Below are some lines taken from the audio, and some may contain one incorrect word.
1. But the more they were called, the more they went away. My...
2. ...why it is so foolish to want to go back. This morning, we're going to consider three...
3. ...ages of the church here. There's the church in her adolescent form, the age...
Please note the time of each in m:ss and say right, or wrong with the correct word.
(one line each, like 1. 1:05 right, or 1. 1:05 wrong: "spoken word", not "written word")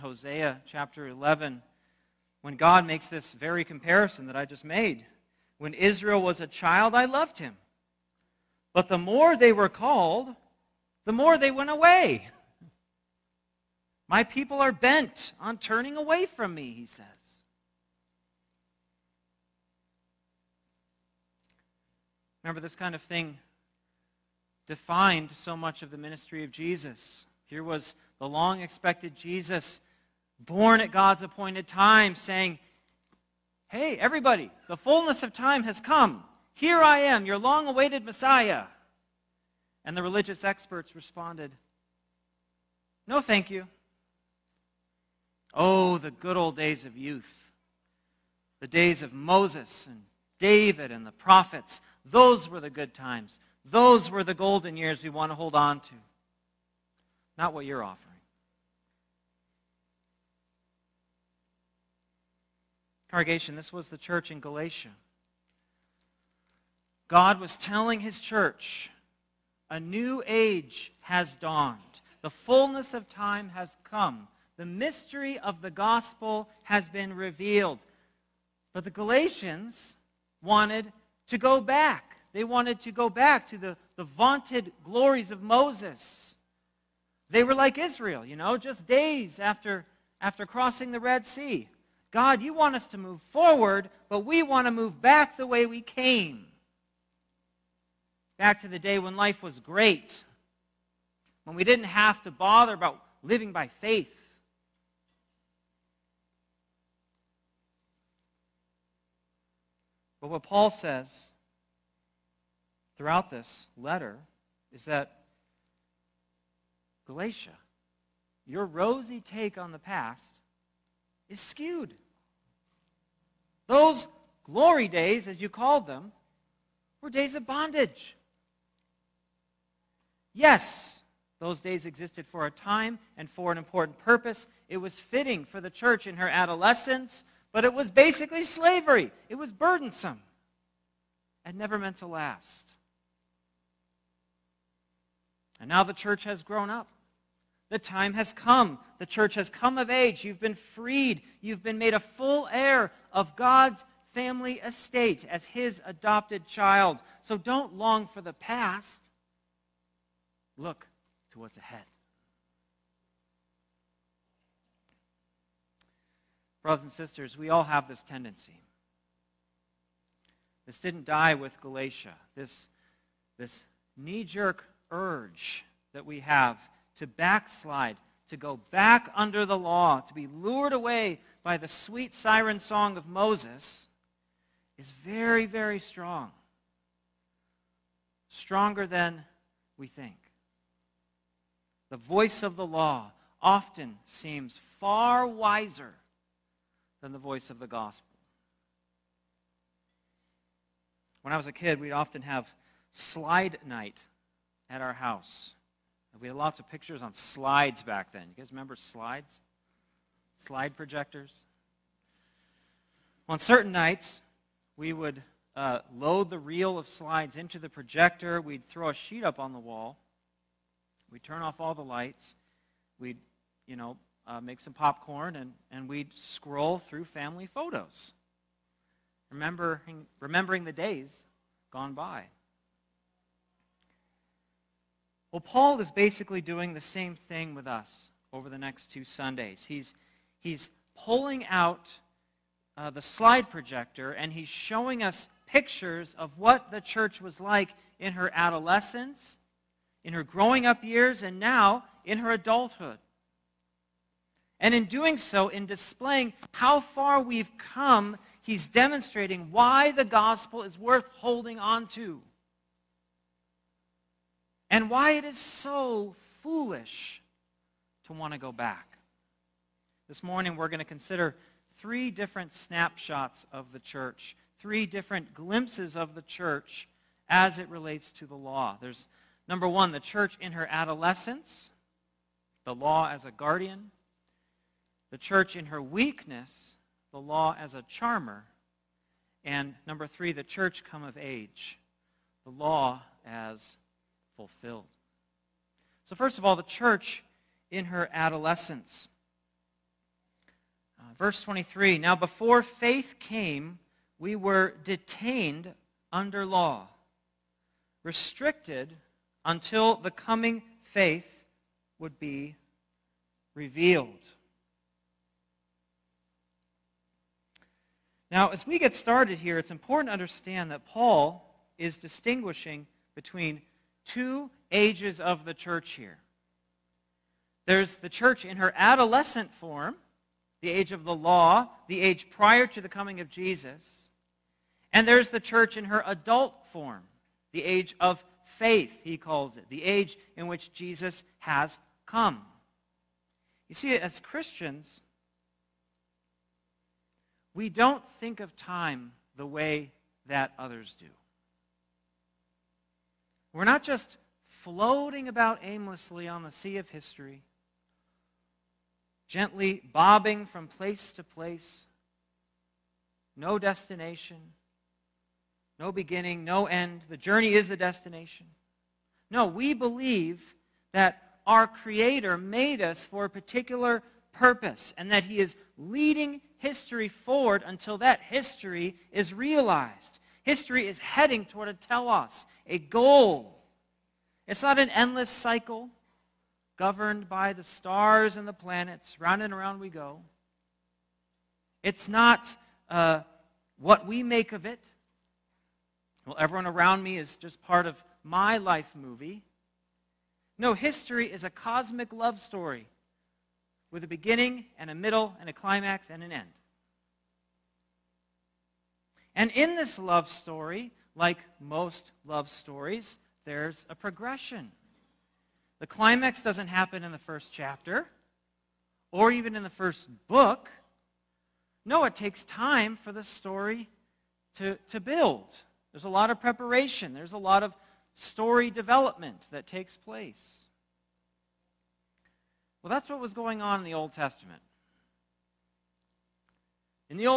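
1. 0:08 right
2. 4:24 right
3. 5:24 right.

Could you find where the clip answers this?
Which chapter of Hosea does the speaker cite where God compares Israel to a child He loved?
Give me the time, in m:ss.
0:00.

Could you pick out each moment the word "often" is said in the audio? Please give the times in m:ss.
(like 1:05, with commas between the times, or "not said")
3:13, 3:21.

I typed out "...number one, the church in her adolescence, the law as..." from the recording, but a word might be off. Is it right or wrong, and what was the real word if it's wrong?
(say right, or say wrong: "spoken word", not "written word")
right.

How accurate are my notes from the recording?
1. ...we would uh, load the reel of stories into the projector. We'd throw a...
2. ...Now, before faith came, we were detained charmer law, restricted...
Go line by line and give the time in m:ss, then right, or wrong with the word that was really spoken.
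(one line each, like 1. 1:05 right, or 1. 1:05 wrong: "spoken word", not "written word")
1. 3:34 wrong: "slides", not "stories"
2. 5:01 wrong: "under", not "charmer".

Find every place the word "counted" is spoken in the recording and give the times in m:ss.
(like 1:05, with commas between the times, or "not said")
not said.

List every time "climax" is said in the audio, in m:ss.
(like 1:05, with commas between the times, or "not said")
6:45, 6:55.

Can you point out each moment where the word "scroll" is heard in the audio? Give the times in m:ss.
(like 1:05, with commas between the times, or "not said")
3:46.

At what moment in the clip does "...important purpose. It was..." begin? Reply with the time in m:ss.
2:13.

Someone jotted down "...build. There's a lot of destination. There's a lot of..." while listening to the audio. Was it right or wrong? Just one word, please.
wrong.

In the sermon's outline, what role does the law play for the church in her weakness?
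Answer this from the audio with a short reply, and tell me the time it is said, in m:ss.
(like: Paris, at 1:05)
A charmer, at 4:47.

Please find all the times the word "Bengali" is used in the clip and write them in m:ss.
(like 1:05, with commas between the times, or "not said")
not said.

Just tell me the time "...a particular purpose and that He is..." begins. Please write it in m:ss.
6:13.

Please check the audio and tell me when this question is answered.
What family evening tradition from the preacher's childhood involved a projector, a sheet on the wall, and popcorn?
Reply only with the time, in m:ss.
3:22.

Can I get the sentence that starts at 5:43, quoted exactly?
You see, as Christians, we don't think of time the way that others do.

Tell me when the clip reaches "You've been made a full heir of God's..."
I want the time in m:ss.
2:31.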